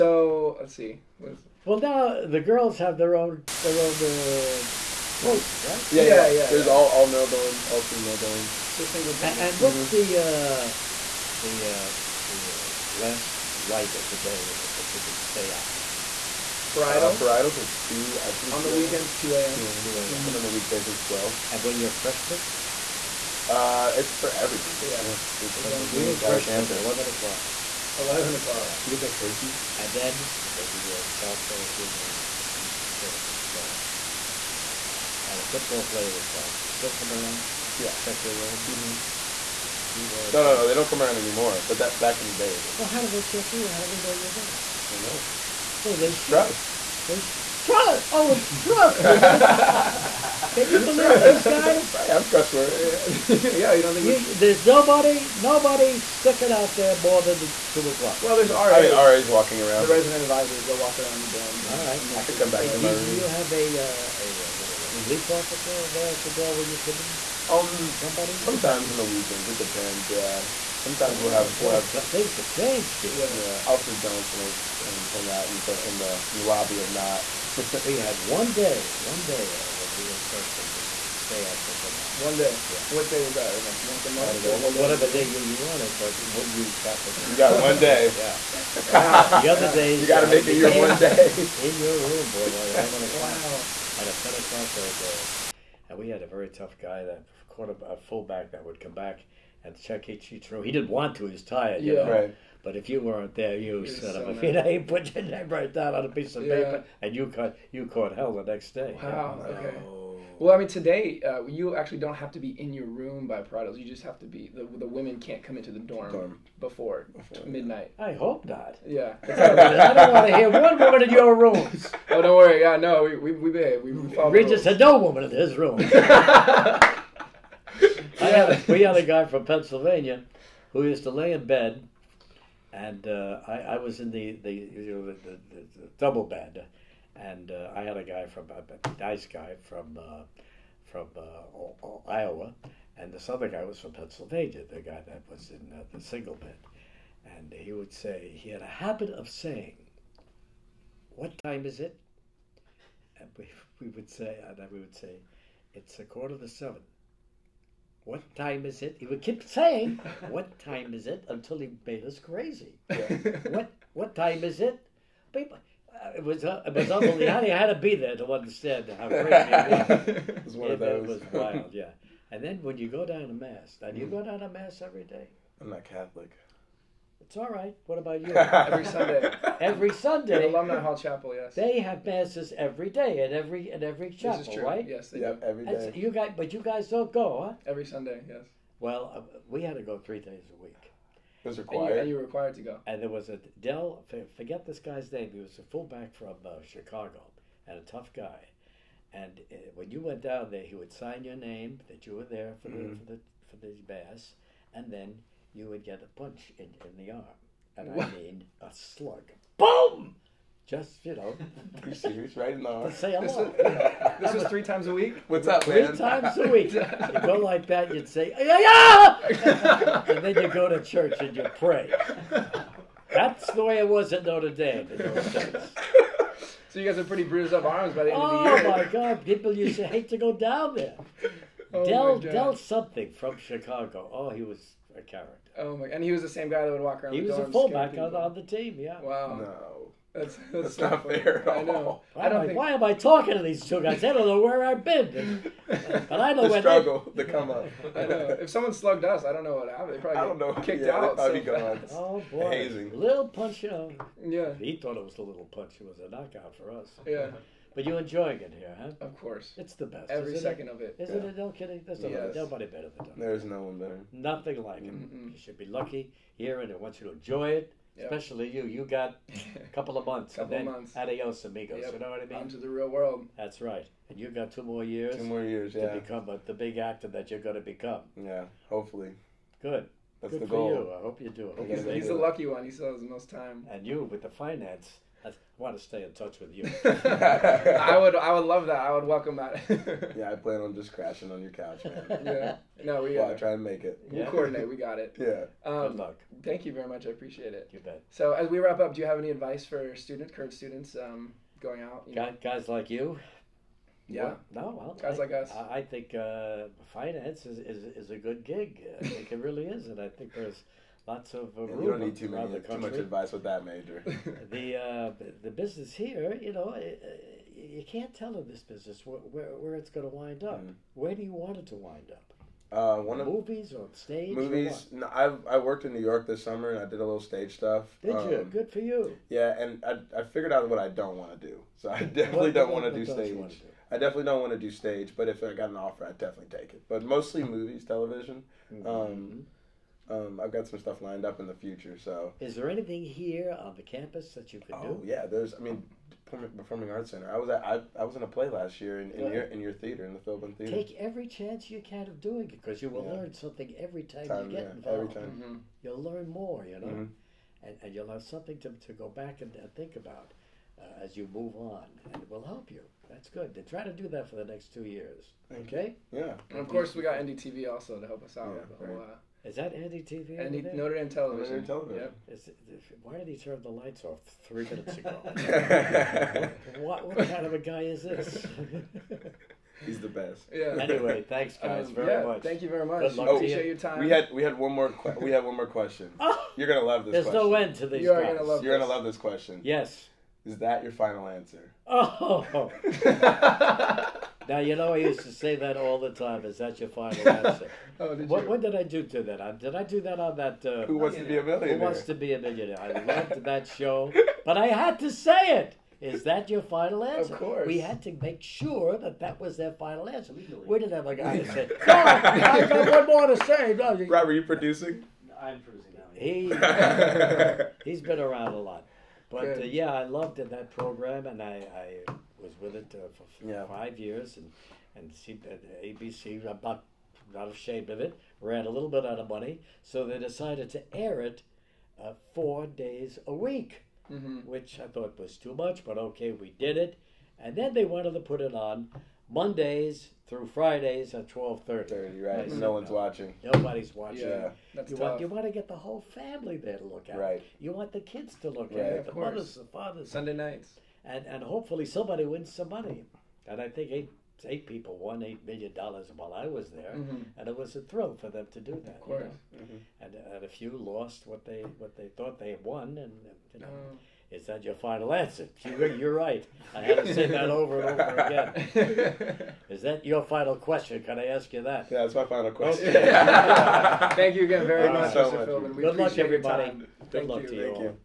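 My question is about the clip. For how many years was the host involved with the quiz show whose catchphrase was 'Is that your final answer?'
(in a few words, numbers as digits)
5.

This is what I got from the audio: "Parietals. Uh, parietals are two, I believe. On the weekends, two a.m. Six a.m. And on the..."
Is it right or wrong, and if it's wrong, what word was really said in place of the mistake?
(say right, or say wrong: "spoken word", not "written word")
wrong: "Two", not "Six".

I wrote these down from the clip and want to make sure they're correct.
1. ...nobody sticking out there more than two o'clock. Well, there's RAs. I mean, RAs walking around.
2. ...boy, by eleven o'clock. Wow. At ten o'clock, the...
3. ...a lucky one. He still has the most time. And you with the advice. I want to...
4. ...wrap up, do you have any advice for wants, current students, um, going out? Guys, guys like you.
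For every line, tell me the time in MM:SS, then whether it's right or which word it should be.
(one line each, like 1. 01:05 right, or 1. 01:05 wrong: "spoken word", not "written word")
1. 00:55 right
2. 01:32 right
3. 04:42 wrong: "finance", not "advice"
4. 04:58 wrong: "students", not "wants".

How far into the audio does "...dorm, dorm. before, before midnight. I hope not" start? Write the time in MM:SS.
01:55.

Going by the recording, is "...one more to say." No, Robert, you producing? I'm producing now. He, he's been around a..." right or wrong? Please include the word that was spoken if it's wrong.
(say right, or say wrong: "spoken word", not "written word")
right.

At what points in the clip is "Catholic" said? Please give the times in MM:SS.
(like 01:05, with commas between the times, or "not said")
02:55.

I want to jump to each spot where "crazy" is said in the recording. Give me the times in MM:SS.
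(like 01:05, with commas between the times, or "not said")
02:42, 02:49.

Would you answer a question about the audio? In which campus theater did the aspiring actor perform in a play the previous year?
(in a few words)
Philbin Theater.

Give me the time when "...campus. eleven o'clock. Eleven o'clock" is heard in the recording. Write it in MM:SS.
00:26.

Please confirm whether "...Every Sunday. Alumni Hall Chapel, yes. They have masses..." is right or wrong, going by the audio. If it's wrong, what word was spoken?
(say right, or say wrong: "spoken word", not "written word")
right.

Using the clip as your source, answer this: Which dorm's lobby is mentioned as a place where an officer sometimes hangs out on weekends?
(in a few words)
Knott.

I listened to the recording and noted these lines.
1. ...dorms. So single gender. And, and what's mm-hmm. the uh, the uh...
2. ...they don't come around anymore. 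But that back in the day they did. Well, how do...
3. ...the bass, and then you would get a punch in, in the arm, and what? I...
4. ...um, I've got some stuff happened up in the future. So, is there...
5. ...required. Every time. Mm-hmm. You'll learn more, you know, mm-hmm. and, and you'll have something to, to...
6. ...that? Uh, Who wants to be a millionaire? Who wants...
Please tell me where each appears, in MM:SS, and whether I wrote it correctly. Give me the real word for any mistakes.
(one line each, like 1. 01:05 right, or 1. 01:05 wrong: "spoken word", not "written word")
1. 00:08 right
2. 00:40 right
3. 03:23 right
4. 05:40 wrong: "lined", not "happened"
5. 05:54 wrong: "involved", not "required"
6. 06:40 right.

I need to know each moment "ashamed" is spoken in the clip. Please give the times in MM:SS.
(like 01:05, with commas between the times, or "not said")
07:07.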